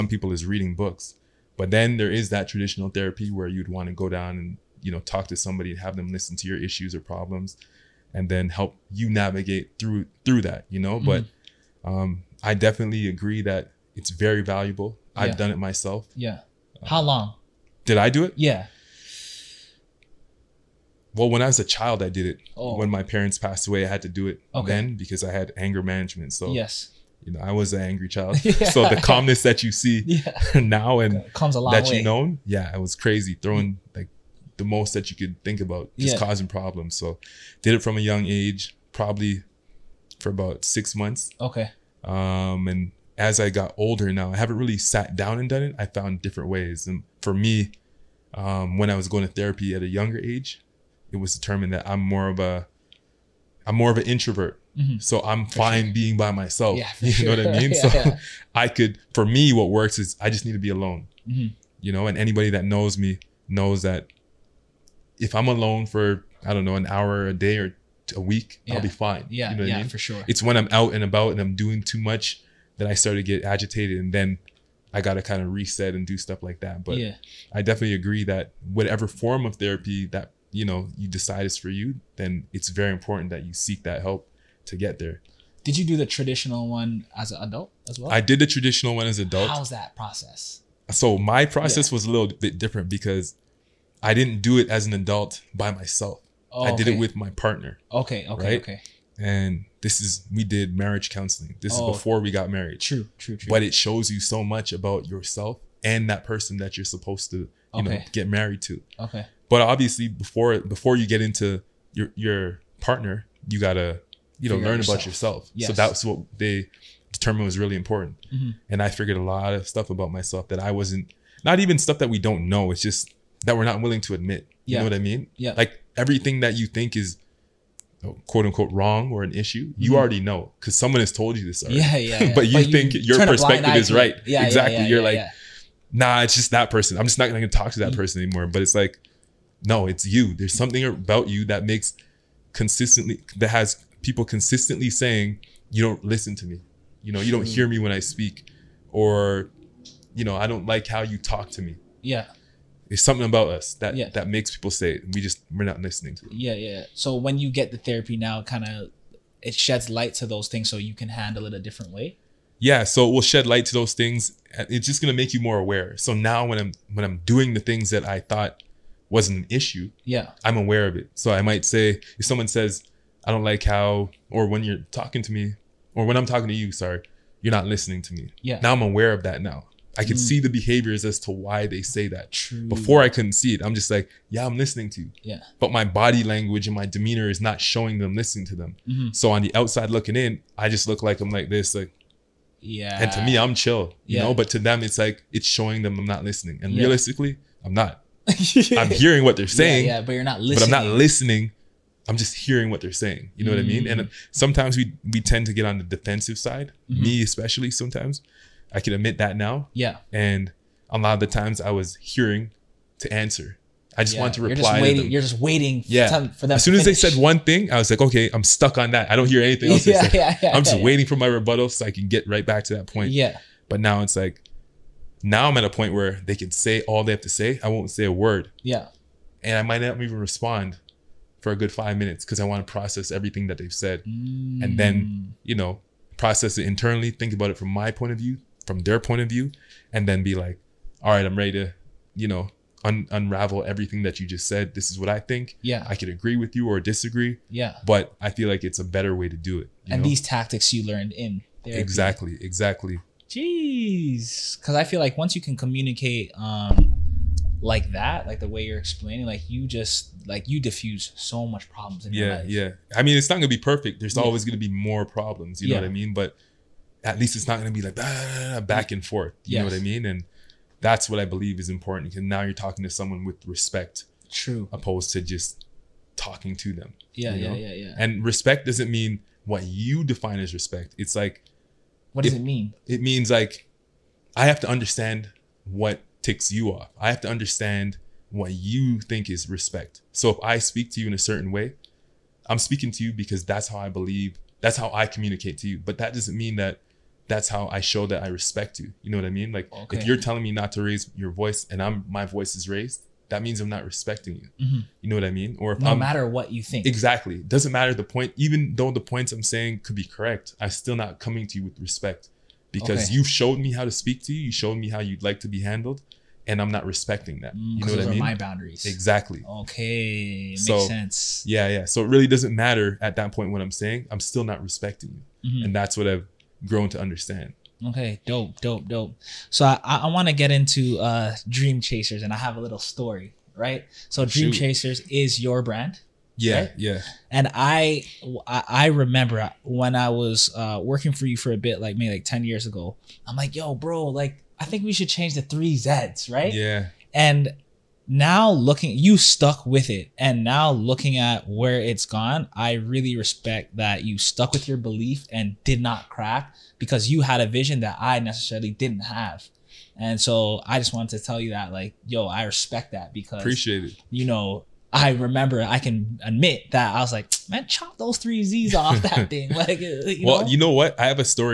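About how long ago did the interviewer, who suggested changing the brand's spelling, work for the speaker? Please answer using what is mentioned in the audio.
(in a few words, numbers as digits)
10 years ago.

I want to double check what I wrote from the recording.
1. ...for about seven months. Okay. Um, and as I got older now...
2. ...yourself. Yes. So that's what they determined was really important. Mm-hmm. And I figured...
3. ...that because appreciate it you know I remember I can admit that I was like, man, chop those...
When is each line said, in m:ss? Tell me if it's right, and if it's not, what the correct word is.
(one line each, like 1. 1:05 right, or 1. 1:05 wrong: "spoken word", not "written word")
1. 0:40 wrong: "six", not "seven"
2. 1:55 right
3. 6:02 right.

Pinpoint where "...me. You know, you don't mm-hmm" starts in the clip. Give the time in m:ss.
2:26.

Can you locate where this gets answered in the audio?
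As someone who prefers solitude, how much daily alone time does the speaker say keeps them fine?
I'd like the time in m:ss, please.
1:06.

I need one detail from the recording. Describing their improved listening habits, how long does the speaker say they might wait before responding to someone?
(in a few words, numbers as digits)
5 minutes.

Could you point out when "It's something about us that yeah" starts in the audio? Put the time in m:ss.
2:32.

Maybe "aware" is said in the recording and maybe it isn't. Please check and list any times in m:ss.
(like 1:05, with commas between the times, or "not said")
2:45, 2:50, 2:58.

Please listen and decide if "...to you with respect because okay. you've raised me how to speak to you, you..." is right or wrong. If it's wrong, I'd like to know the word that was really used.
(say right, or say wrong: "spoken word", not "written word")
wrong: "showed", not "raised".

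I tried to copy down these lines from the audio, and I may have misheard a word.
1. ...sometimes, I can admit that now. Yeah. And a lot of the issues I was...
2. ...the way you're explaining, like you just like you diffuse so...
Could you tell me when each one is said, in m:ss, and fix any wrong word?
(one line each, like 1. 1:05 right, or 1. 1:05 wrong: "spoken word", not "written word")
1. 3:27 wrong: "times", not "issues"
2. 4:18 right.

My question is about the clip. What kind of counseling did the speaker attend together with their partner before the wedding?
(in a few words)
marriage counseling.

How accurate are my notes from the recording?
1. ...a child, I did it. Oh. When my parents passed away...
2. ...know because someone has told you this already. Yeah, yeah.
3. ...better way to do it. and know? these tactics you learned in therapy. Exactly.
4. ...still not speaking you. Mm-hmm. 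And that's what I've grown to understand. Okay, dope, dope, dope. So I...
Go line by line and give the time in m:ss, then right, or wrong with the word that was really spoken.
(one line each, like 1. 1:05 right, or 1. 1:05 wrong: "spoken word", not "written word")
1. 0:21 right
2. 2:10 right
3. 4:08 right
4. 5:24 wrong: "respecting", not "speaking".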